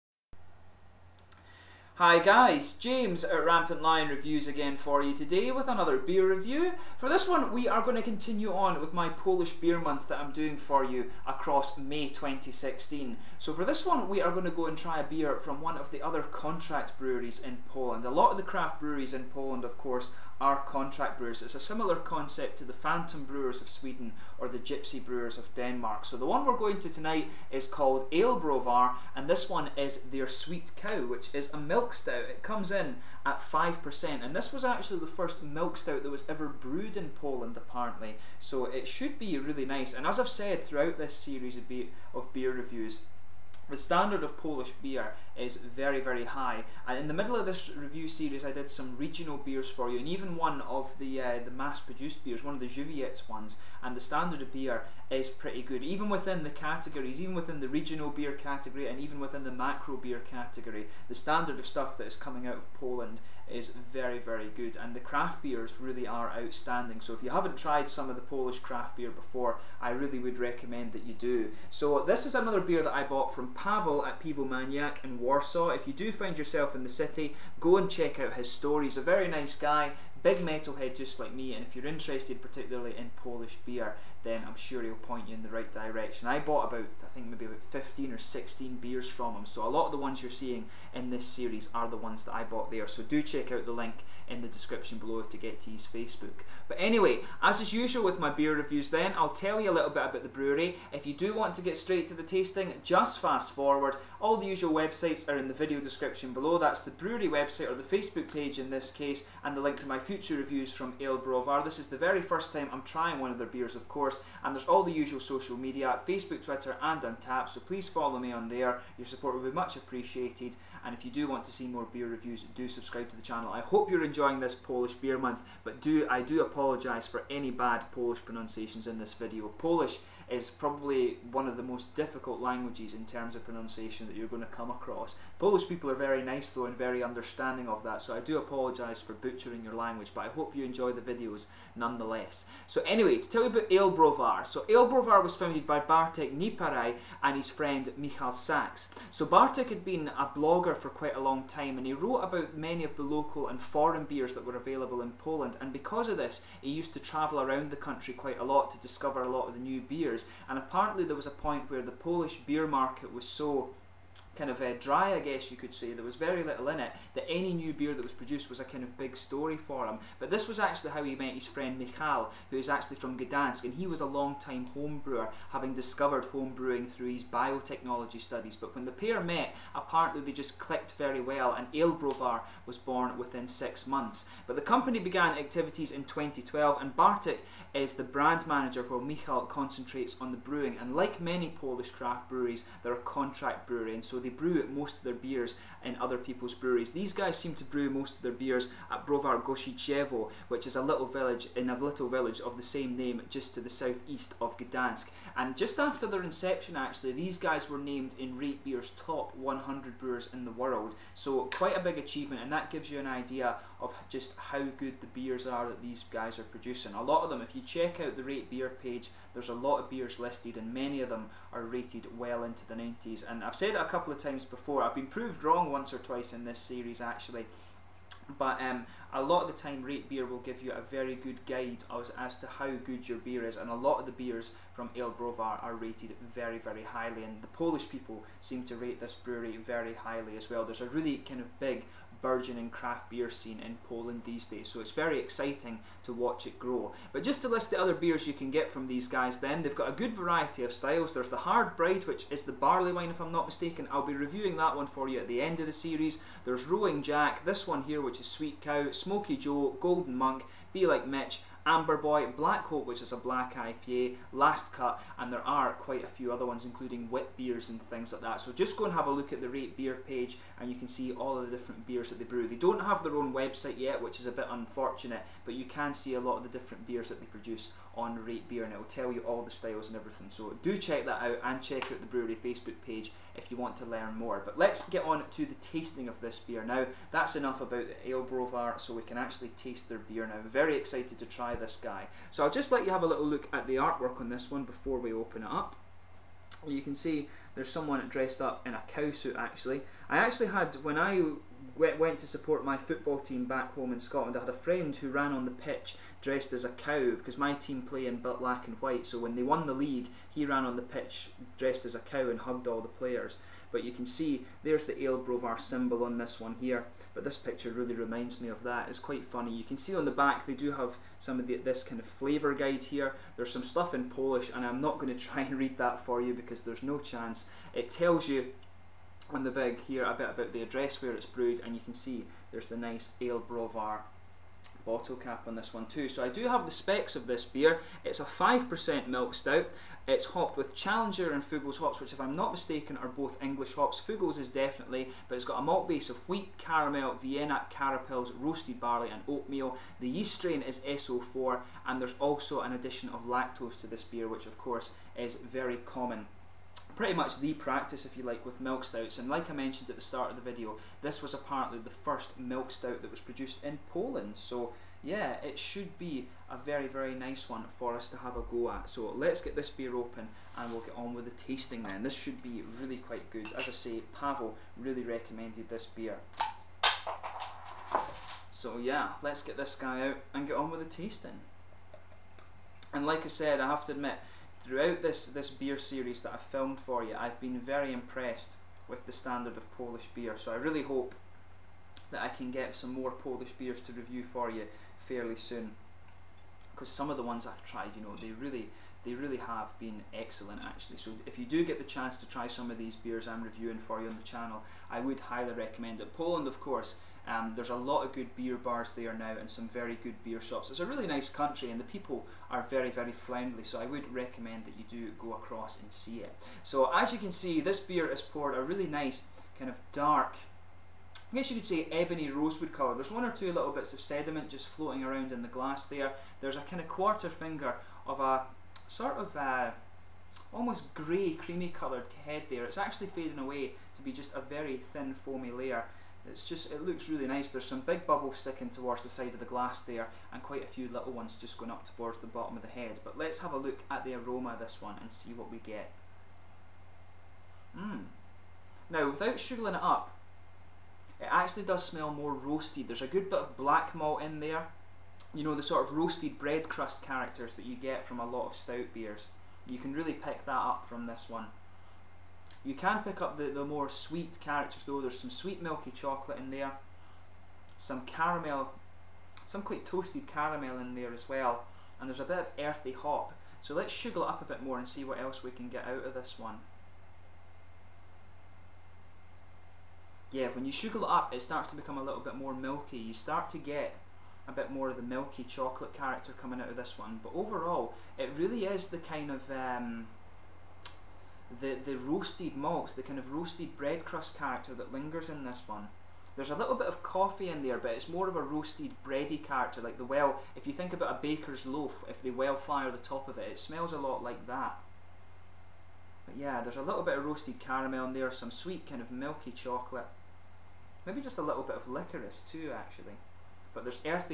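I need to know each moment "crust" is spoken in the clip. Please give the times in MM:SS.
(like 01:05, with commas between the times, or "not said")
07:36, 08:14.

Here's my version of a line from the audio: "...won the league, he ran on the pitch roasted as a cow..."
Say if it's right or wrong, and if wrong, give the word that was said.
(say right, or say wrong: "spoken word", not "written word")
wrong: "dressed", not "roasted".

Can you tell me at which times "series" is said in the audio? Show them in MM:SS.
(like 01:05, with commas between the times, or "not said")
00:41, 00:48, 01:31, 03:46, 04:15, 06:25.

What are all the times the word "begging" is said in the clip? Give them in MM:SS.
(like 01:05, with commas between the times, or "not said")
not said.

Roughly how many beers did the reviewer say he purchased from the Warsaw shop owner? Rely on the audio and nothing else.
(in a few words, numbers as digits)
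15 or 16.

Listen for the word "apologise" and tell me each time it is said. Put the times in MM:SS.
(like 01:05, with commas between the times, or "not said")
02:06, 02:18.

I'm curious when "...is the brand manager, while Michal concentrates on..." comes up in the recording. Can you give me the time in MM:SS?
03:07.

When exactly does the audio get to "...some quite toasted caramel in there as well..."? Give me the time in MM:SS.
07:49.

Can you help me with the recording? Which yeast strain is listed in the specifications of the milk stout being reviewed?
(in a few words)
SO4.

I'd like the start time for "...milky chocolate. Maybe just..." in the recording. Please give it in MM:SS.
08:29.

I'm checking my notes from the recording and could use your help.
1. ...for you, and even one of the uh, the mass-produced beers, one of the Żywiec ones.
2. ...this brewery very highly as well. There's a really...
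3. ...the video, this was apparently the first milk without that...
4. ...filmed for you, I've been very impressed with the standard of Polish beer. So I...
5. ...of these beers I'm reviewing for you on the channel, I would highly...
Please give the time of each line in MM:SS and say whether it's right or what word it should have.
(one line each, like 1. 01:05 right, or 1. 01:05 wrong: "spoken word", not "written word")
1. 00:49 right
2. 03:59 right
3. 06:00 wrong: "stout", not "without"
4. 06:26 right
5. 06:42 right.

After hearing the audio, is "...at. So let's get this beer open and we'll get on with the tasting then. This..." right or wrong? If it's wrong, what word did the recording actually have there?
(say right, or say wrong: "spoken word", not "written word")
right.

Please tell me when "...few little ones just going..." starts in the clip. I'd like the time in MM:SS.
07:20.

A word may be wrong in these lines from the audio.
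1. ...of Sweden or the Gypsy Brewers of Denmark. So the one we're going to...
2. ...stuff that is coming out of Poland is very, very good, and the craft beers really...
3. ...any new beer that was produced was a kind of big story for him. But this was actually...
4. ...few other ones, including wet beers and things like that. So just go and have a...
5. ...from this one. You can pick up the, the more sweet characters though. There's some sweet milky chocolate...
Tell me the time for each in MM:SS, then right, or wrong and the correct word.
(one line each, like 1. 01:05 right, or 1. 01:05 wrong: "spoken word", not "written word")
1. 00:23 right
2. 01:01 right
3. 02:47 right
4. 04:26 right
5. 07:40 right.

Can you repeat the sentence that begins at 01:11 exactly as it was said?
So, this is another beer that I bought from Pavel at Piwomaniak in Warsaw.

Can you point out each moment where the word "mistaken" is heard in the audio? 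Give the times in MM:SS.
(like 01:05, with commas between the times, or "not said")
04:13, 05:42.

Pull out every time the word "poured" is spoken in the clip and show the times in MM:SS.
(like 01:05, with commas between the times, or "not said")
06:58.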